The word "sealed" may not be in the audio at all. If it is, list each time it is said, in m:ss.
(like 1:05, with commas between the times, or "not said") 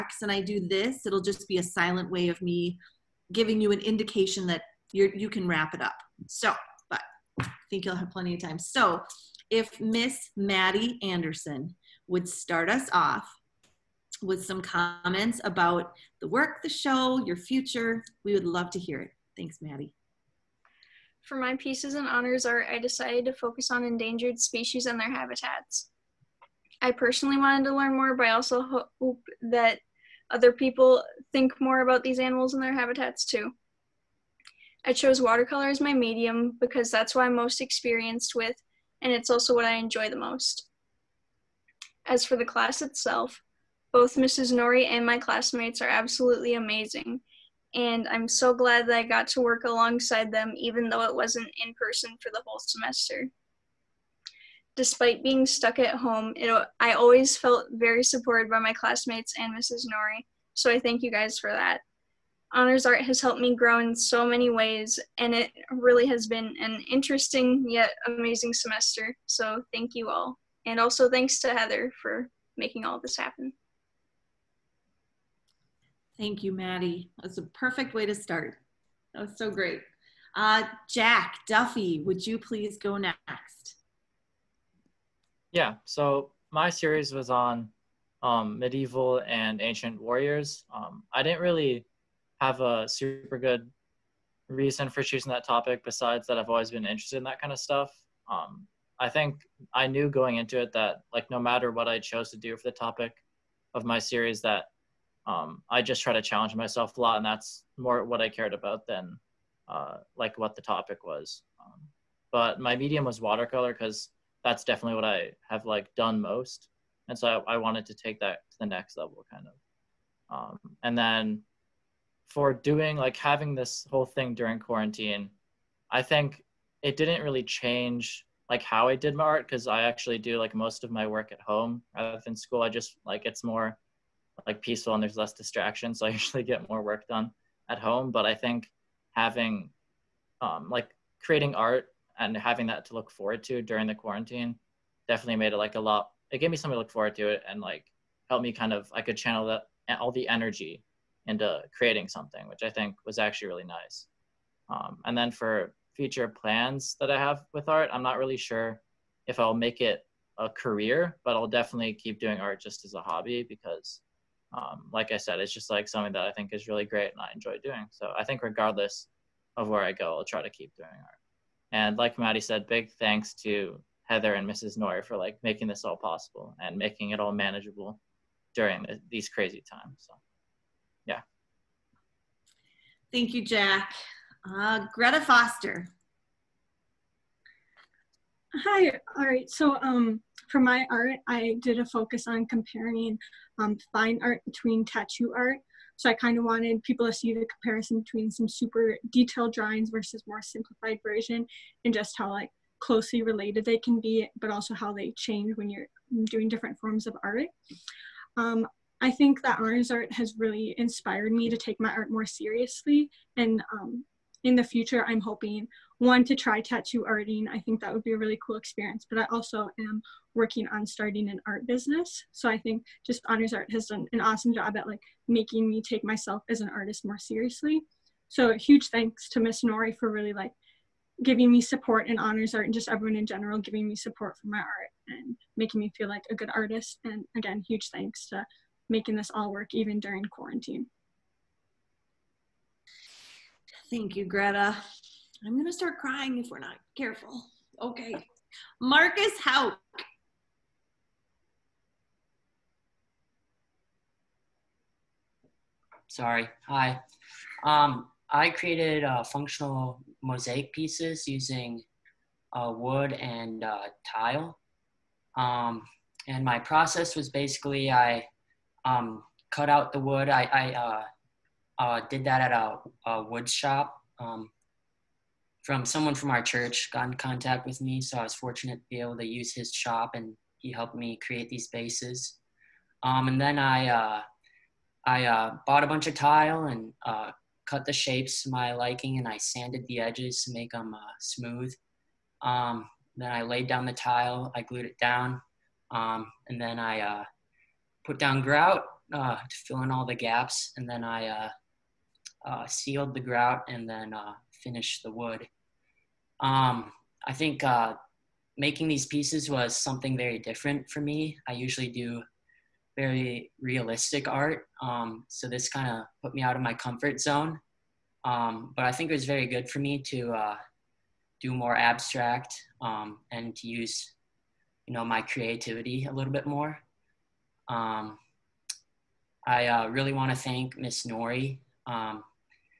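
5:02.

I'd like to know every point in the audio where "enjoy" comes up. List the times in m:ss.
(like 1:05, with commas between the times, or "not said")
0:39, 2:47.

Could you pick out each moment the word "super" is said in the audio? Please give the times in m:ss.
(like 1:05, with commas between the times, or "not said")
1:32, 3:18.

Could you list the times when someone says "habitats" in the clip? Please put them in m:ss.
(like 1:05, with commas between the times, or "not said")
0:25, 0:32.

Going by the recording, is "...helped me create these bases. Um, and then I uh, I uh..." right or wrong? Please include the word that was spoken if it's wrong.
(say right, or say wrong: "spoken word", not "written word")
right.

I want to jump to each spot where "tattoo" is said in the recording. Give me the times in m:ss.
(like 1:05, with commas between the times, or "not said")
3:14, 3:36.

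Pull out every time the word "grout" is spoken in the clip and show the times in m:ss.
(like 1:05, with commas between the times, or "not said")
4:58, 5:03.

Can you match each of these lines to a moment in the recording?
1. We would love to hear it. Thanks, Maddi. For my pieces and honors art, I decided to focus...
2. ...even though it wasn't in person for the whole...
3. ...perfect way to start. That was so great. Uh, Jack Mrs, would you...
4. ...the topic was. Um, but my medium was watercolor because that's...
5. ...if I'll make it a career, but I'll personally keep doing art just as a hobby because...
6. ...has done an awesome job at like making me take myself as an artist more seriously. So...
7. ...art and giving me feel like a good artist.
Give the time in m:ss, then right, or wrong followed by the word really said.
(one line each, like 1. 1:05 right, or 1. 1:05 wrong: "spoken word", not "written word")
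1. 0:18 right
2. 0:50 right
3. 1:17 wrong: "Duffy", not "Mrs"
4. 1:50 right
5. 2:39 wrong: "definitely", not "personally"
6. 3:43 right
7. 3:54 wrong: "making", not "giving".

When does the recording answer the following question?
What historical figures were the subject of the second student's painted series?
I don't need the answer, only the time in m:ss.
1:28.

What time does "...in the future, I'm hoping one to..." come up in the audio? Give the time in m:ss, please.
3:34.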